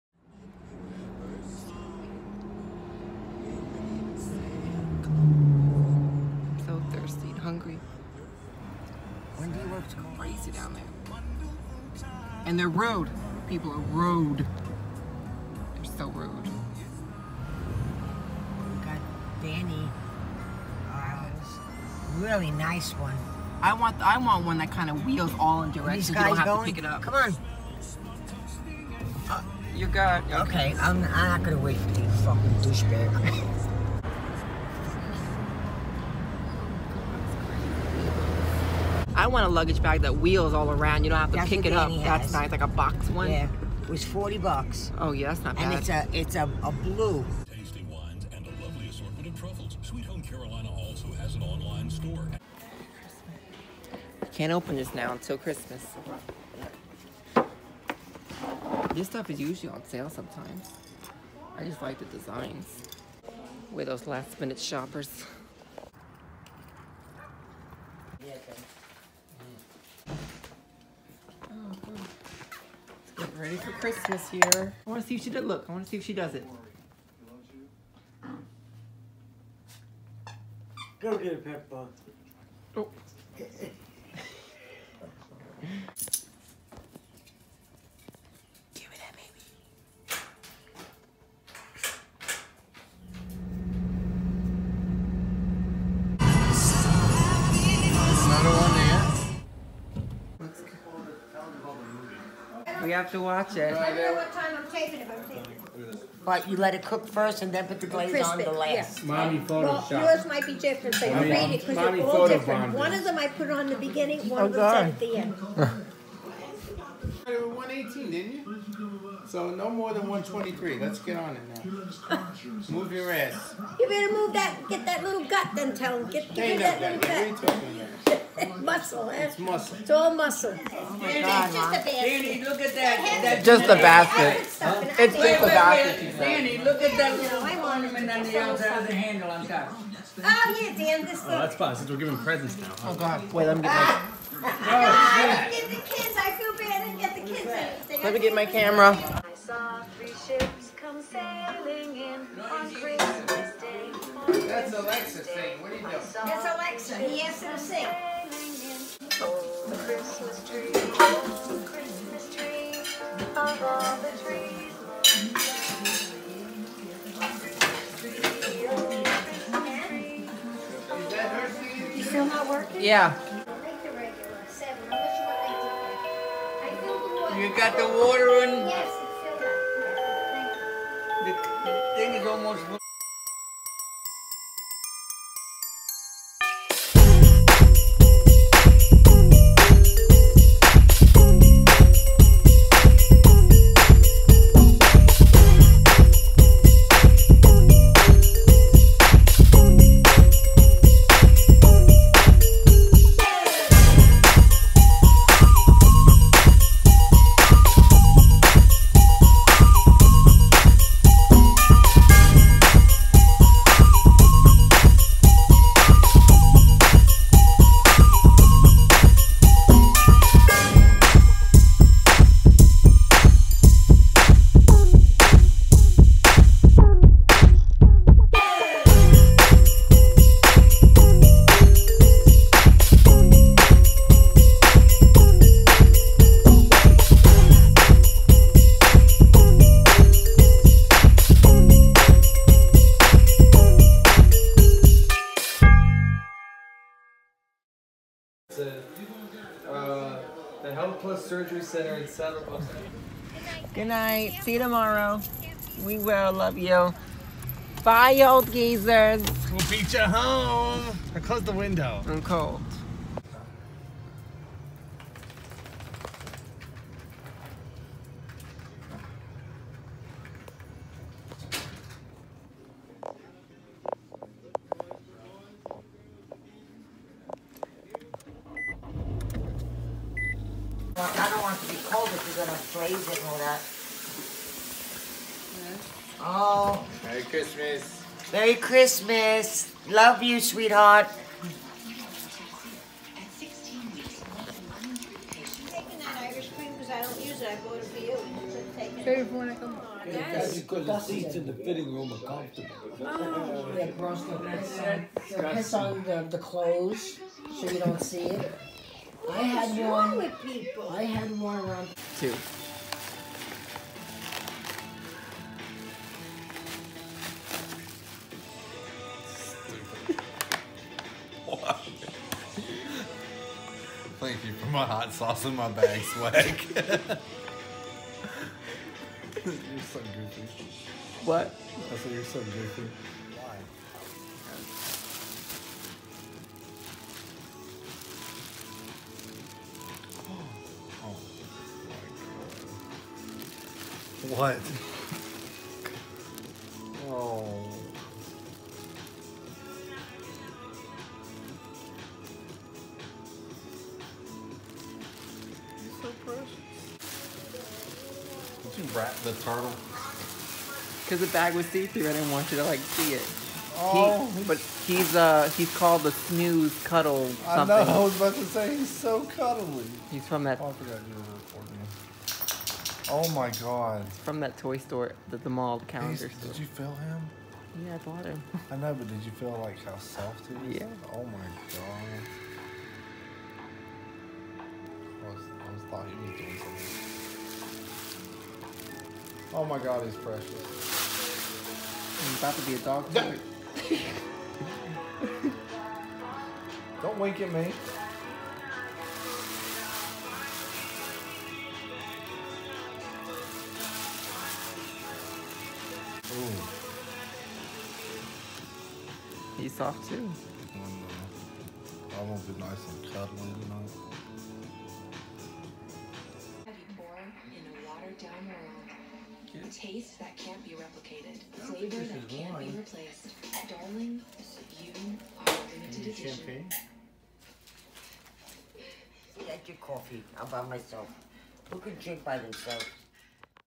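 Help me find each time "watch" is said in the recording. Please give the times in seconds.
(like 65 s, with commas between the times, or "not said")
103 s.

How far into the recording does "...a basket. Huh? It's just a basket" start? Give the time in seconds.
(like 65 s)
133 s.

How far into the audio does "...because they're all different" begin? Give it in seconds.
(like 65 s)
111 s.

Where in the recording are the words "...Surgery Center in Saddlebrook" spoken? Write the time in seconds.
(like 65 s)
251 s.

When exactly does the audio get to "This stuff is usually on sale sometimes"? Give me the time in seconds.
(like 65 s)
58 s.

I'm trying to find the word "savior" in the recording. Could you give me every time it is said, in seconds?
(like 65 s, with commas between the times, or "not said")
not said.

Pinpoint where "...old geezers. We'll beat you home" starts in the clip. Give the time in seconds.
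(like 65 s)
258 s.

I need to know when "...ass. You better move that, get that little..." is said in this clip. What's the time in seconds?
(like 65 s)
123 s.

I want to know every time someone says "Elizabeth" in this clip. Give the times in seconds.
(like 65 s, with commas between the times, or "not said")
not said.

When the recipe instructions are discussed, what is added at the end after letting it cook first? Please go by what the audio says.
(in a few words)
The glaze.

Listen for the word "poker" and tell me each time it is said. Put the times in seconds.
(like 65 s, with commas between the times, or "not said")
not said.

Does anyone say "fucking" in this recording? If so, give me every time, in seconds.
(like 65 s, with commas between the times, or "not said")
32 s.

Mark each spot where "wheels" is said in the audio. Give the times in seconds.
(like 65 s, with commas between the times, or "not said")
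25 s, 40 s.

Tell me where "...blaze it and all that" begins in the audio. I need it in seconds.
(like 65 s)
282 s.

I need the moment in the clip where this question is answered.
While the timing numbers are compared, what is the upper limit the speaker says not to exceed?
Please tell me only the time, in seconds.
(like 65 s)
120 s.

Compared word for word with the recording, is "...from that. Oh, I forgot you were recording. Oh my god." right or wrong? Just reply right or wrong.
right.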